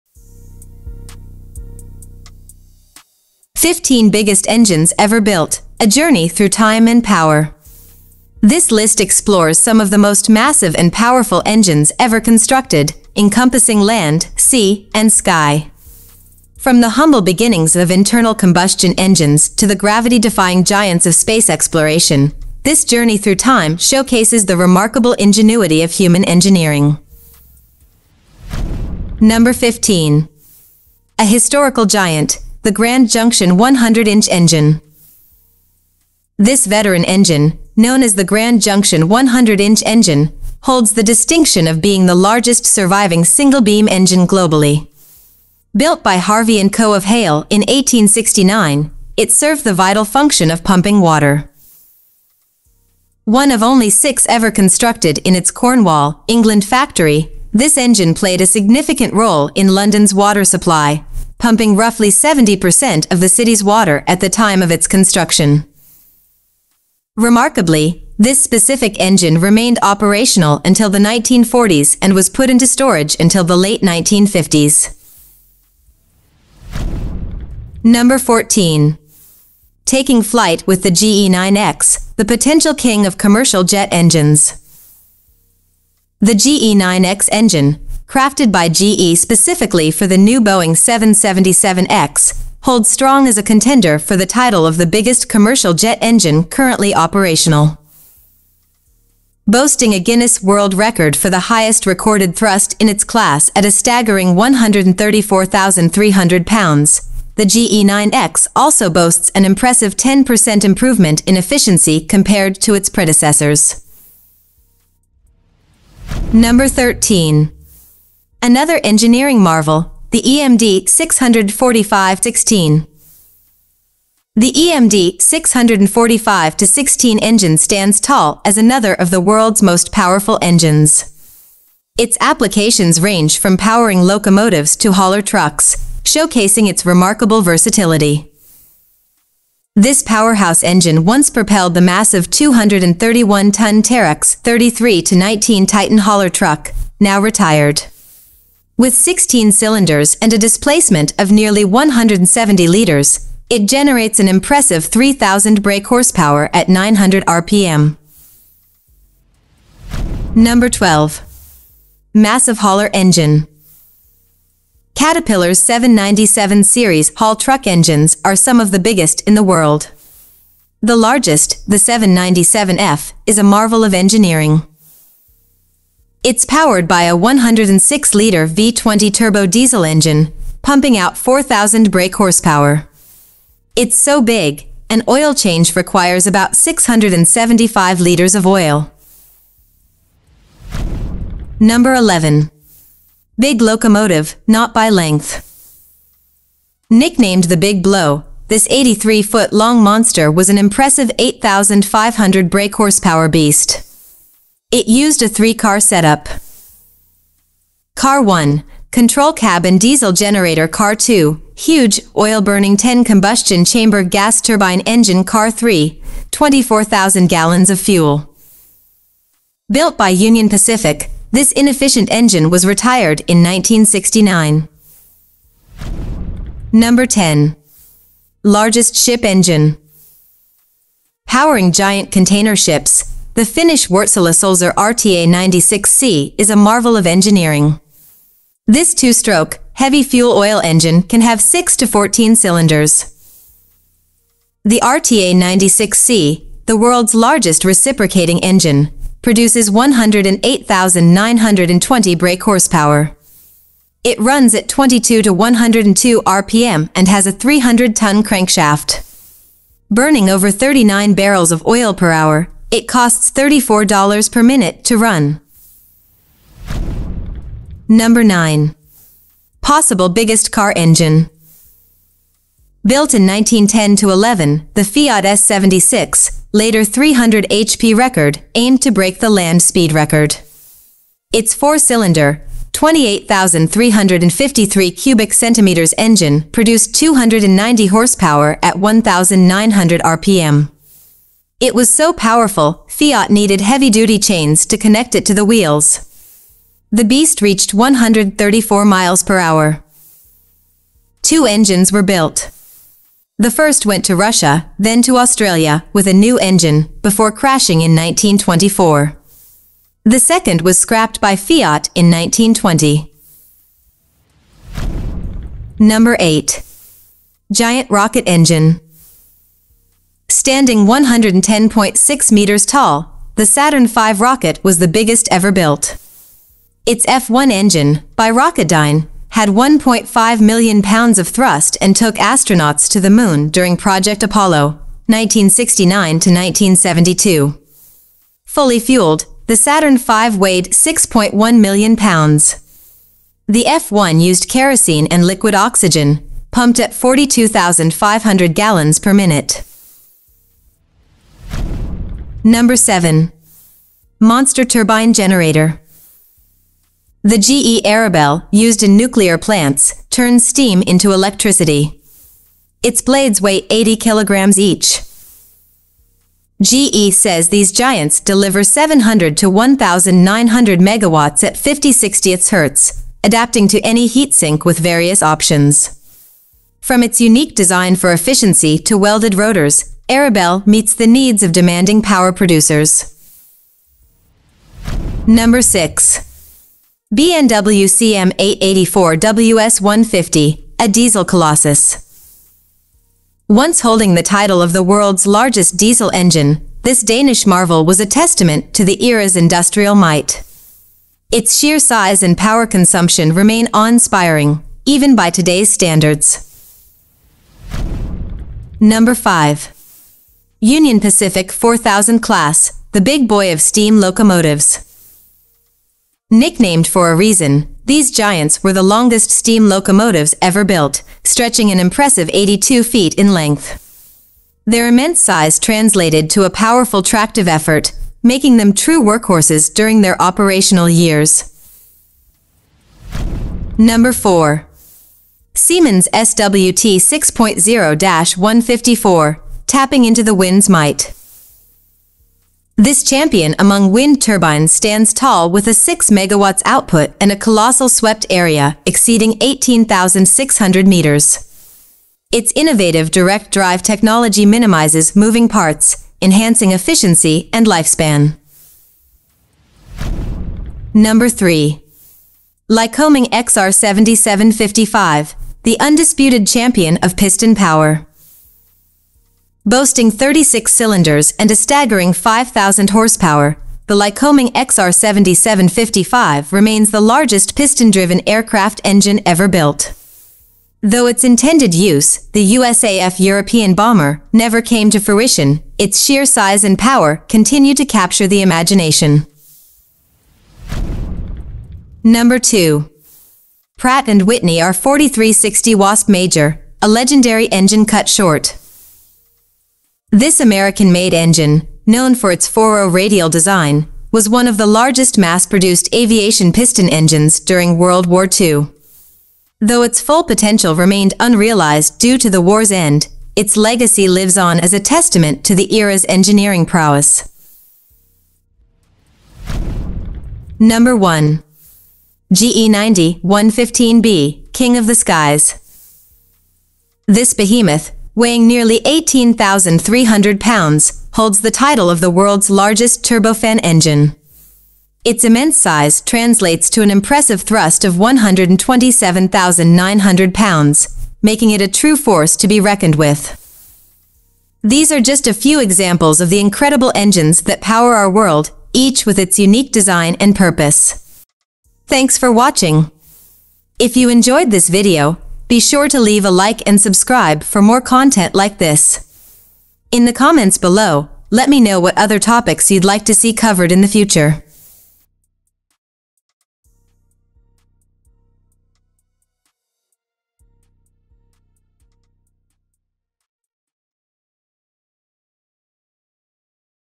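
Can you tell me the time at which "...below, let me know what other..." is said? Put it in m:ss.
9:20.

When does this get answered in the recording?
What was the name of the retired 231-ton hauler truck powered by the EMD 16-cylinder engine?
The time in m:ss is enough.
2:23.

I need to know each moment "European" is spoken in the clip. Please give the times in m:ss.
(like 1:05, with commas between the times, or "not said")
8:03.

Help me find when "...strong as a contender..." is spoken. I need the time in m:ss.
1:32.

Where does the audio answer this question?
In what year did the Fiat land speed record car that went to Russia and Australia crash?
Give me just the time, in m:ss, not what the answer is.
5:07.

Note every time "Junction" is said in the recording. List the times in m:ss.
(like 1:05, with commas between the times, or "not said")
0:33, 0:38.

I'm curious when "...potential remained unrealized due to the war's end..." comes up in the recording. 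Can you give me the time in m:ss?
8:30.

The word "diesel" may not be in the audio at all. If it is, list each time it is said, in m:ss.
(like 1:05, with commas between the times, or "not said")
2:59, 3:29, 6:30, 6:35.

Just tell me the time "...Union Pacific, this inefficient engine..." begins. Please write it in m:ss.
3:40.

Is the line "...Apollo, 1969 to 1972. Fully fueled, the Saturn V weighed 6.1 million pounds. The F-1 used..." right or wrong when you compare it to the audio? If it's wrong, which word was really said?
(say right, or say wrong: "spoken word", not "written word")
right.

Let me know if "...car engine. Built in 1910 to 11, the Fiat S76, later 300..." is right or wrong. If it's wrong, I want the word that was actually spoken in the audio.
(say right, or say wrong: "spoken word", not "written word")
right.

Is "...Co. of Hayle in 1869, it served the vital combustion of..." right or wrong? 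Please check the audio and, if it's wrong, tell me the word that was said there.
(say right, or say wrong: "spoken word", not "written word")
wrong: "function", not "combustion".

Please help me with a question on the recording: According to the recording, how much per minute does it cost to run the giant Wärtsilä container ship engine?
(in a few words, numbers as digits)
$34.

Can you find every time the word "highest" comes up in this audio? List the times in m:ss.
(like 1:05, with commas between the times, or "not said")
1:41.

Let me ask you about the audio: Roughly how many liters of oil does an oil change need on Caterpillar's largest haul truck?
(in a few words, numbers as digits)
675 liters.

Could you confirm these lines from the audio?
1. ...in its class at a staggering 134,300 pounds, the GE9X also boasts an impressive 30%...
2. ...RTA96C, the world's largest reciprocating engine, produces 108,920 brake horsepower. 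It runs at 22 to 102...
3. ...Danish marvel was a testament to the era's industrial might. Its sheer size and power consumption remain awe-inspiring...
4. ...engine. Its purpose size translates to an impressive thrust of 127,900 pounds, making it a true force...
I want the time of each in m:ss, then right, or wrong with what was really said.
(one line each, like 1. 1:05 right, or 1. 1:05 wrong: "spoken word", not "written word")
1. 1:42 wrong: "10", not "30"
2. 4:04 right
3. 6:37 right
4. 8:53 wrong: "immense", not "purpose".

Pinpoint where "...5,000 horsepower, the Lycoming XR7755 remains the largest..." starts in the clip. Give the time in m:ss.
7:52.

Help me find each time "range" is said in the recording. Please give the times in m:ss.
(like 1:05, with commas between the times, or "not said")
2:12.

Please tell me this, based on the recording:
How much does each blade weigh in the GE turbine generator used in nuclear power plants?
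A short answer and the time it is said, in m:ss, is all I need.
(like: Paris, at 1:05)
80 kilograms, at 6:03.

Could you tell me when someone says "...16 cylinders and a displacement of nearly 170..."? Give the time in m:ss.
2:28.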